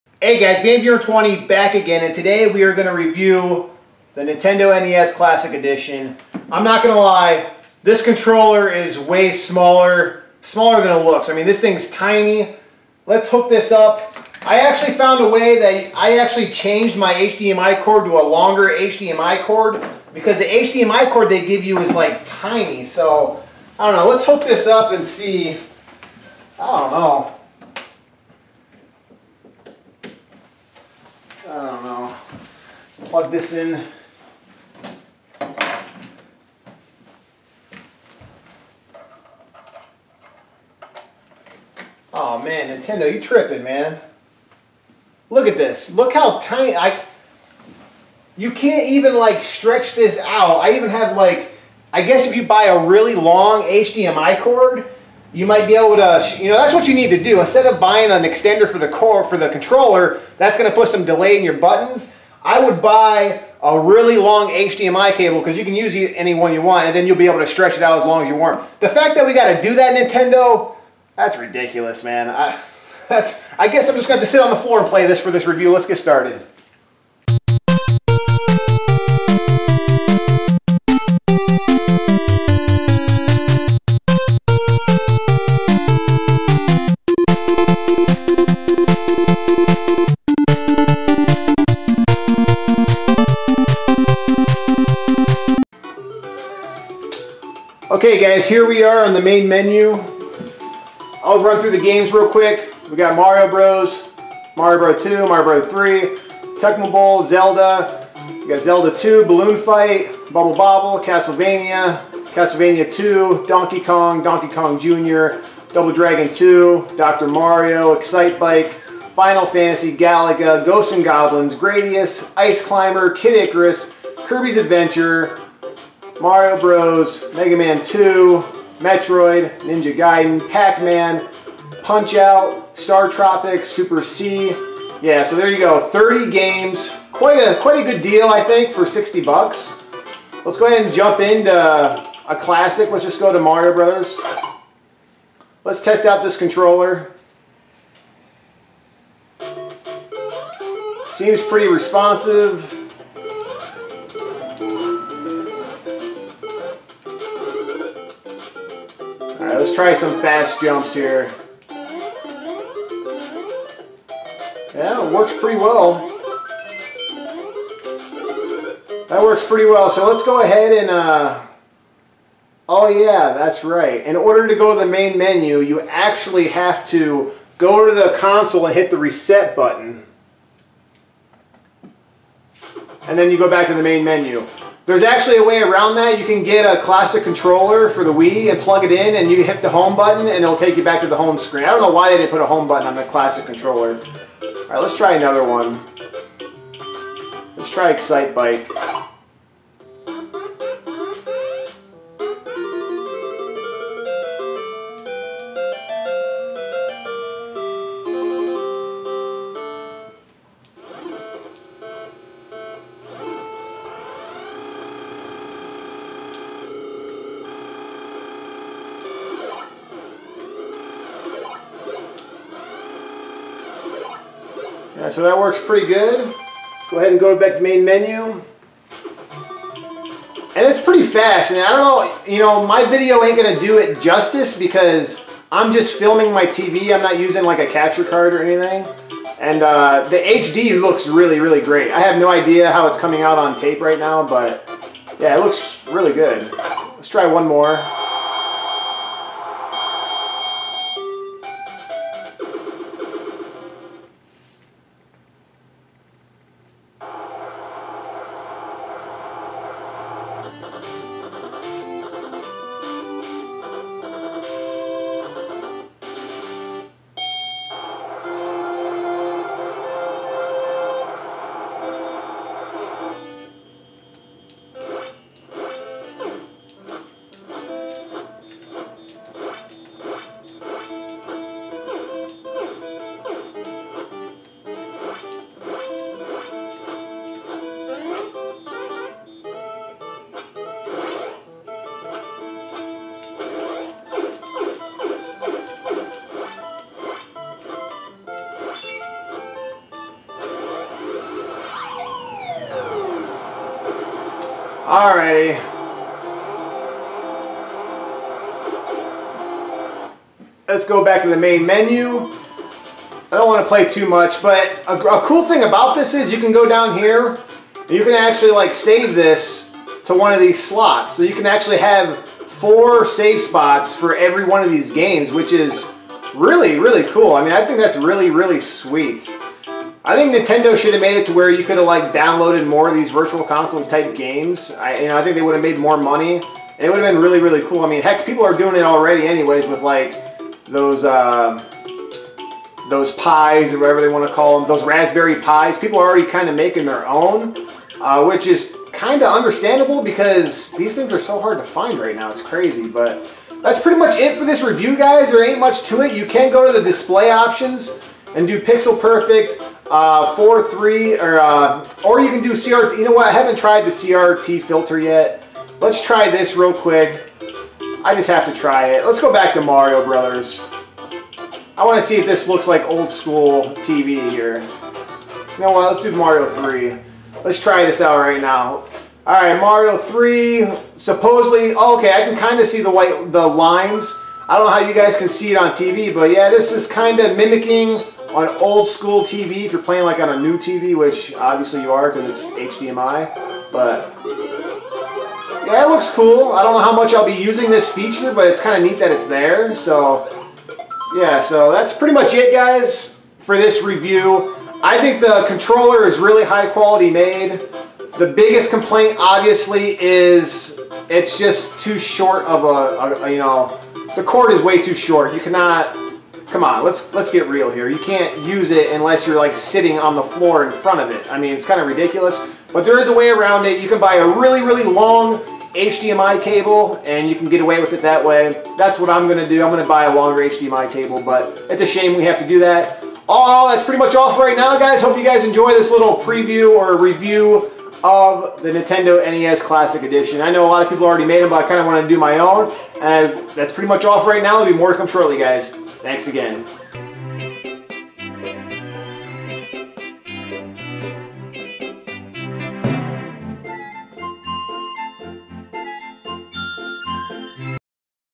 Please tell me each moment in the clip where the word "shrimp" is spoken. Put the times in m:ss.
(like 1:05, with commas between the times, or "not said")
not said.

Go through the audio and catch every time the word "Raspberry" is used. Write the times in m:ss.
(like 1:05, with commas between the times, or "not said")
5:44.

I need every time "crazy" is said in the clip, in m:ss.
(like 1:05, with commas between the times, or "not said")
5:52.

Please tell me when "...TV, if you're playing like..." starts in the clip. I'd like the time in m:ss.
6:29.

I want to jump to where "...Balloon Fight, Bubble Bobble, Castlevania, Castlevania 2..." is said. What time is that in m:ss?
1:49.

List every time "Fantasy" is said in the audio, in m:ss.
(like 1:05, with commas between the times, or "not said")
1:59.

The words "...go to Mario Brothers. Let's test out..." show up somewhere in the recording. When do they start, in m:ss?
2:23.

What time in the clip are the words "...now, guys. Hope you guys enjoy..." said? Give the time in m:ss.
7:14.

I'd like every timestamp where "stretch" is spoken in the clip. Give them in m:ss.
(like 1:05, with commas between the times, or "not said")
0:49, 1:07.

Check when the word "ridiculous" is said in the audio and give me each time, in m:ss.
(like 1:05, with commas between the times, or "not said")
1:11, 7:01.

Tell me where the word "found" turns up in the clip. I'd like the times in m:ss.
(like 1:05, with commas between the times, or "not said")
0:14.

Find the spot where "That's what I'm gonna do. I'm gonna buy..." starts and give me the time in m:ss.
7:08.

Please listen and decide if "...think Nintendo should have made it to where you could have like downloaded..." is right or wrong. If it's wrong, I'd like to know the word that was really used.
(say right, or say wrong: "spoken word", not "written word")
right.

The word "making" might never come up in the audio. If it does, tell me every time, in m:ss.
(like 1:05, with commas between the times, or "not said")
5:46.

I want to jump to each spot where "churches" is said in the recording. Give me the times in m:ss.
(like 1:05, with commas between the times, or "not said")
not said.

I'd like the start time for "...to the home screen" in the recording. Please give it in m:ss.
3:11.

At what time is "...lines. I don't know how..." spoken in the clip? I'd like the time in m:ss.
6:23.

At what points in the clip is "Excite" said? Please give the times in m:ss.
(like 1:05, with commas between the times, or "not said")
1:57, 3:17.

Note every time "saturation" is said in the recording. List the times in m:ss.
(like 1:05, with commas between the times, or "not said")
not said.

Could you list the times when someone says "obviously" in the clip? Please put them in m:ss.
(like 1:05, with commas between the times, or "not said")
6:31, 6:49.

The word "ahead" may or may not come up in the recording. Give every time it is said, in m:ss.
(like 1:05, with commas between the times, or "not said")
2:20, 2:50, 3:46.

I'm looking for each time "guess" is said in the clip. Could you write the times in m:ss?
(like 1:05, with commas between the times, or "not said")
0:52, 1:13.